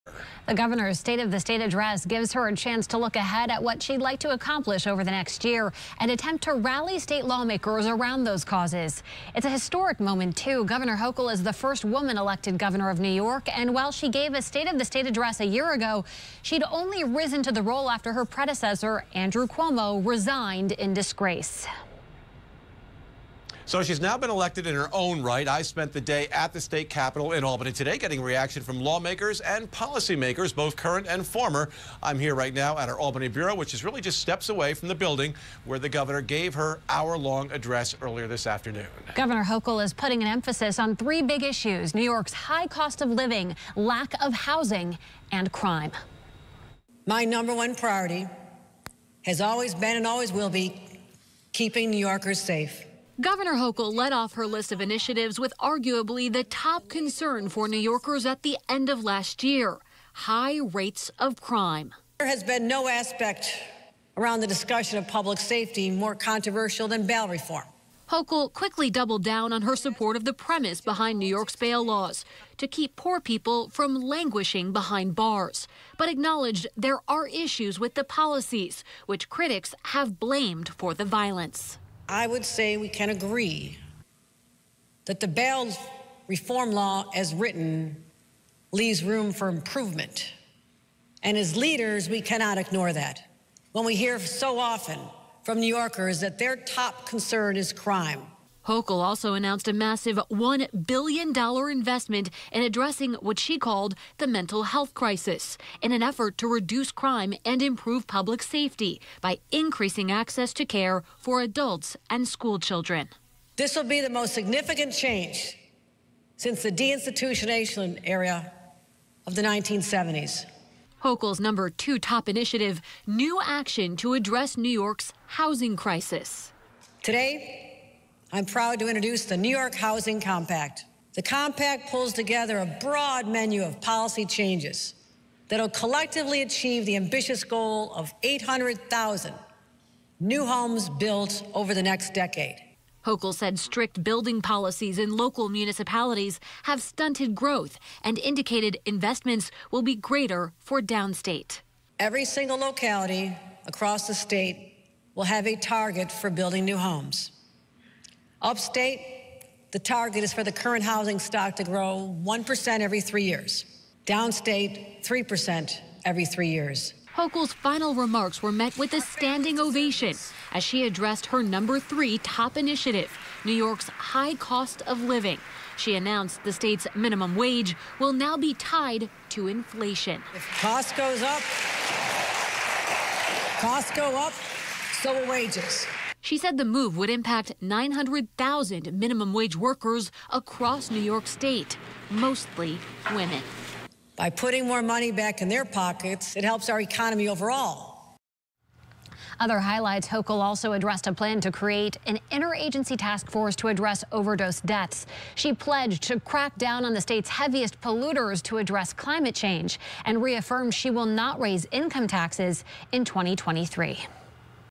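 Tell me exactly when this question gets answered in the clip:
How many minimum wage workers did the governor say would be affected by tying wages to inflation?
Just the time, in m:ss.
3:07.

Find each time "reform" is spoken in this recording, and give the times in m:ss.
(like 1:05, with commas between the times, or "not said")
1:07, 1:26.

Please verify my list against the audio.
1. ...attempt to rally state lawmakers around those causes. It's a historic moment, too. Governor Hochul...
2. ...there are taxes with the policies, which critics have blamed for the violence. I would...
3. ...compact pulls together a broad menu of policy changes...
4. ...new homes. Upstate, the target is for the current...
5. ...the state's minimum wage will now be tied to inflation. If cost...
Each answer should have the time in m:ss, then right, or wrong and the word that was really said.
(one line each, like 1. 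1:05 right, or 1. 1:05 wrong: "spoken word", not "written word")
1. 0:06 right
2. 1:16 wrong: "issues", not "taxes"
3. 2:11 right
4. 2:36 right
5. 2:56 right.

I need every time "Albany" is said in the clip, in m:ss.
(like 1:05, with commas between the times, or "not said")
0:27, 0:32.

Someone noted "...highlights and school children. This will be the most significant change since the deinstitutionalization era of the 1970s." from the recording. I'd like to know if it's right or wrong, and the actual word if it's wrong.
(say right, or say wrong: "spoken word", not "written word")
wrong: "adults", not "highlights".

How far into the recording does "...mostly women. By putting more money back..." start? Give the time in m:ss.
3:12.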